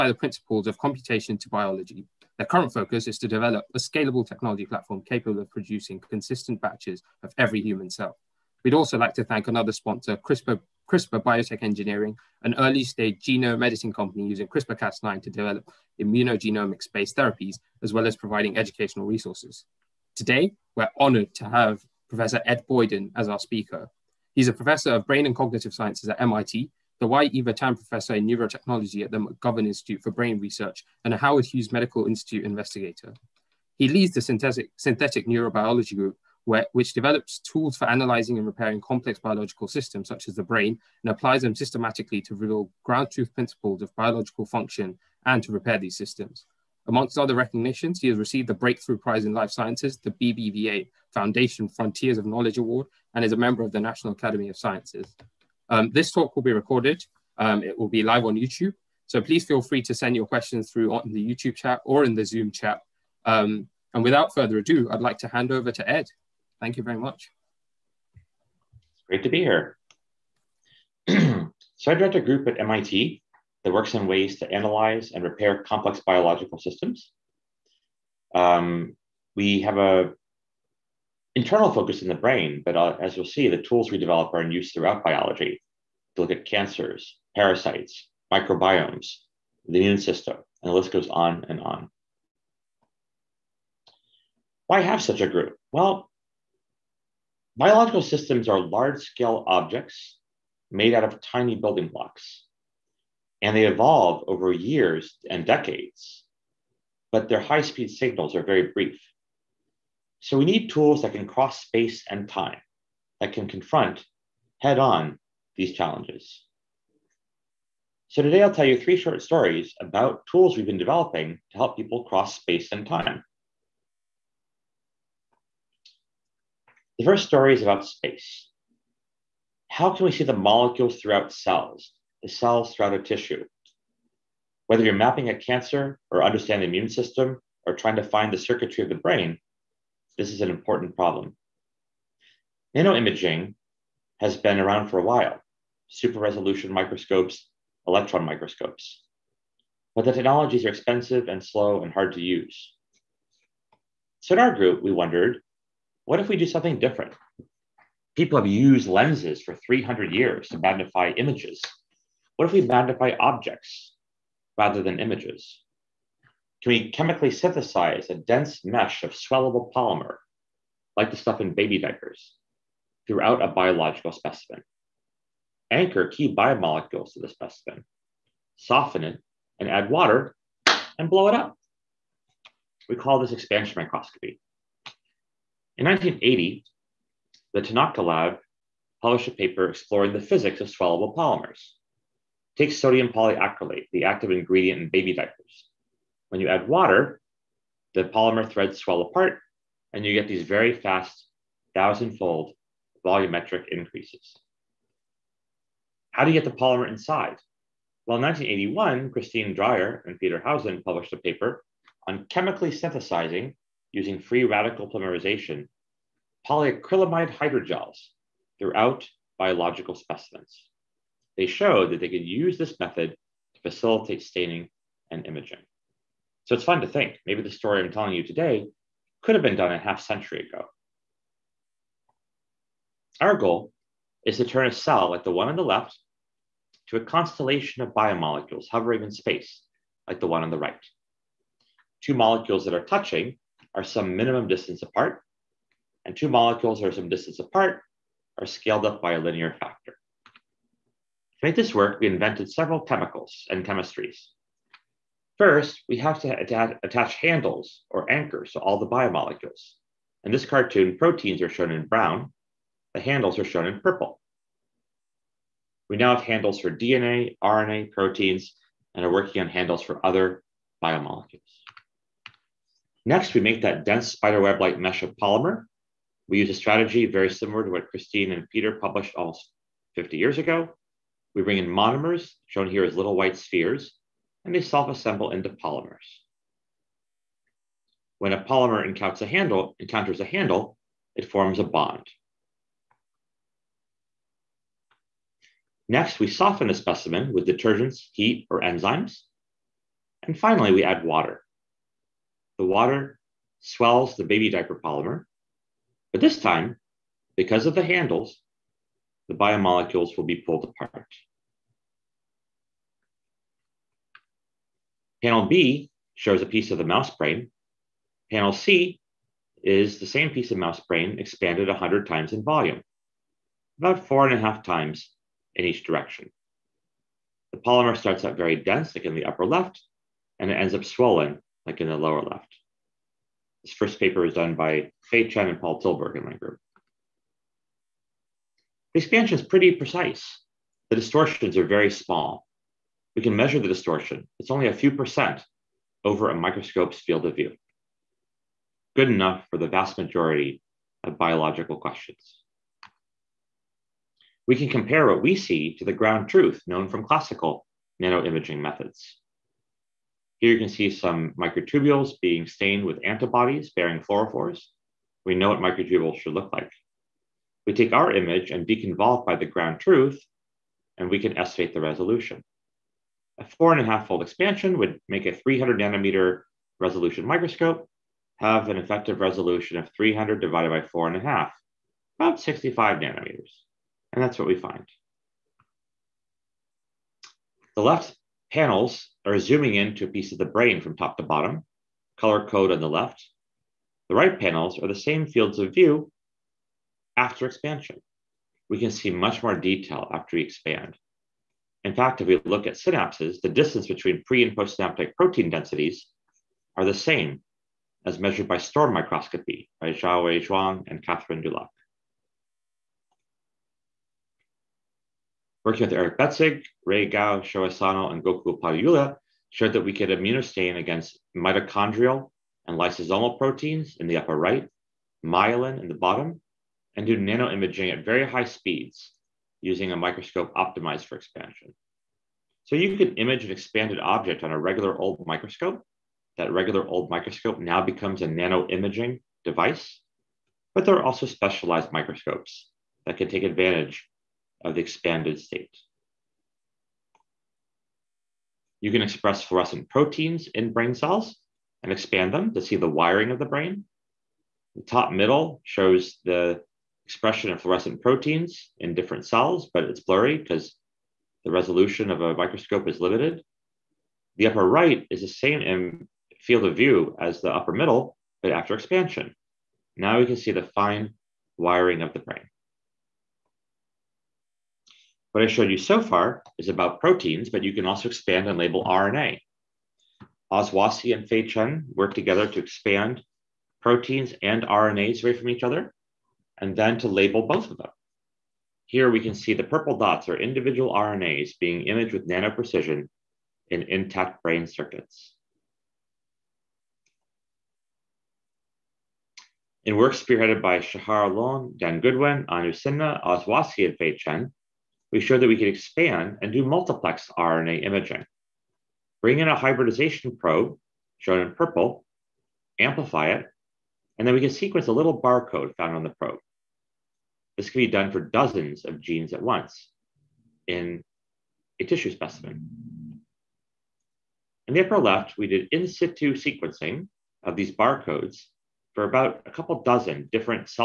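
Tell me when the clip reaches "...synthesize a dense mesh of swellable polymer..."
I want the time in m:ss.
2:47.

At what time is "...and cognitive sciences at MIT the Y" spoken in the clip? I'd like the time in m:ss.
0:25.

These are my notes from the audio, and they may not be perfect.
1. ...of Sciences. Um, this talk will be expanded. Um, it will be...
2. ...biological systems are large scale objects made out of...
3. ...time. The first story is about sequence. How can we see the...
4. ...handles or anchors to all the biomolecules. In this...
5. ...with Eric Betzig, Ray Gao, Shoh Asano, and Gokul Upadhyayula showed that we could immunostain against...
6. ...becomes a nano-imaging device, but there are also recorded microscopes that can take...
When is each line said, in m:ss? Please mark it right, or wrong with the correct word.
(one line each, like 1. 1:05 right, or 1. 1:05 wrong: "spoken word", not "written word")
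1. 0:54 wrong: "recorded", not "expanded"
2. 1:37 right
3. 2:02 wrong: "space", not "sequence"
4. 4:17 right
5. 6:55 right
6. 7:17 wrong: "specialized", not "recorded".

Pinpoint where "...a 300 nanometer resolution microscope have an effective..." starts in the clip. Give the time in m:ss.
6:15.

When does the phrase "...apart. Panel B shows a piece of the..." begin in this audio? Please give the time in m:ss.
5:10.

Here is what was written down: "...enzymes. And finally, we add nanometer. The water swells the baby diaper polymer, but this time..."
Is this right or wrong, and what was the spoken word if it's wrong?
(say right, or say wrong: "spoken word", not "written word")
wrong: "water", not "nanometer".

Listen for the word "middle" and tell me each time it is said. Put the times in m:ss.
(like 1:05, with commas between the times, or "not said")
7:35, 7:47.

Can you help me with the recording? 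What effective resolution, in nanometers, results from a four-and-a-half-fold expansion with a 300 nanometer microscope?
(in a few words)
65 nanometers.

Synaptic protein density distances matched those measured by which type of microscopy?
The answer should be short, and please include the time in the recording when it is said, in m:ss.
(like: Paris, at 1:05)
STORM microscopy, at 6:48.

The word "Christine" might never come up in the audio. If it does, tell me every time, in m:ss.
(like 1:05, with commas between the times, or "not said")
3:29, 4:37.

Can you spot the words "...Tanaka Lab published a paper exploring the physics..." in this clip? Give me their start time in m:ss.
3:07.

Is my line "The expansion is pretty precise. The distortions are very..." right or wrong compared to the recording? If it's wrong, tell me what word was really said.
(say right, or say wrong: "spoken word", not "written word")
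right.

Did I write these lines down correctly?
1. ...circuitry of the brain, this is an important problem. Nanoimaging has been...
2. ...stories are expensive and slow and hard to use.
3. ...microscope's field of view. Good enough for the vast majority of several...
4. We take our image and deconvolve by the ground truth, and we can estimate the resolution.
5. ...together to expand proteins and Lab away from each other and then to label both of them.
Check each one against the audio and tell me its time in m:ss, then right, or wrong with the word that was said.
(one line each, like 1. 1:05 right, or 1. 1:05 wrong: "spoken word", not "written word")
1. 2:18 right
2. 2:30 wrong: "technologies", not "stories"
3. 5:46 wrong: "biological", not "several"
4. 6:07 right
5. 8:02 wrong: "RNAs", not "Lab".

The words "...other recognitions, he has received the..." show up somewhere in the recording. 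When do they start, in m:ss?
0:47.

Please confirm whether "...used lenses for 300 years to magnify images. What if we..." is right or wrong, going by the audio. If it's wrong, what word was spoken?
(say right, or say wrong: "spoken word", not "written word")
right.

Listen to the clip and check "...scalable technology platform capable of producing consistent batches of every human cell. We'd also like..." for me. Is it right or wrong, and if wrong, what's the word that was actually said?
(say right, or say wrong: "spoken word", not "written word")
right.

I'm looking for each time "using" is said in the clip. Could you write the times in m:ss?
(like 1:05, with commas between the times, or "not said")
0:14, 3:33, 7:09.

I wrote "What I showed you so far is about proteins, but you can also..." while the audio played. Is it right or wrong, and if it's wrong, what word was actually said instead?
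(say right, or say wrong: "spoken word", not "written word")
right.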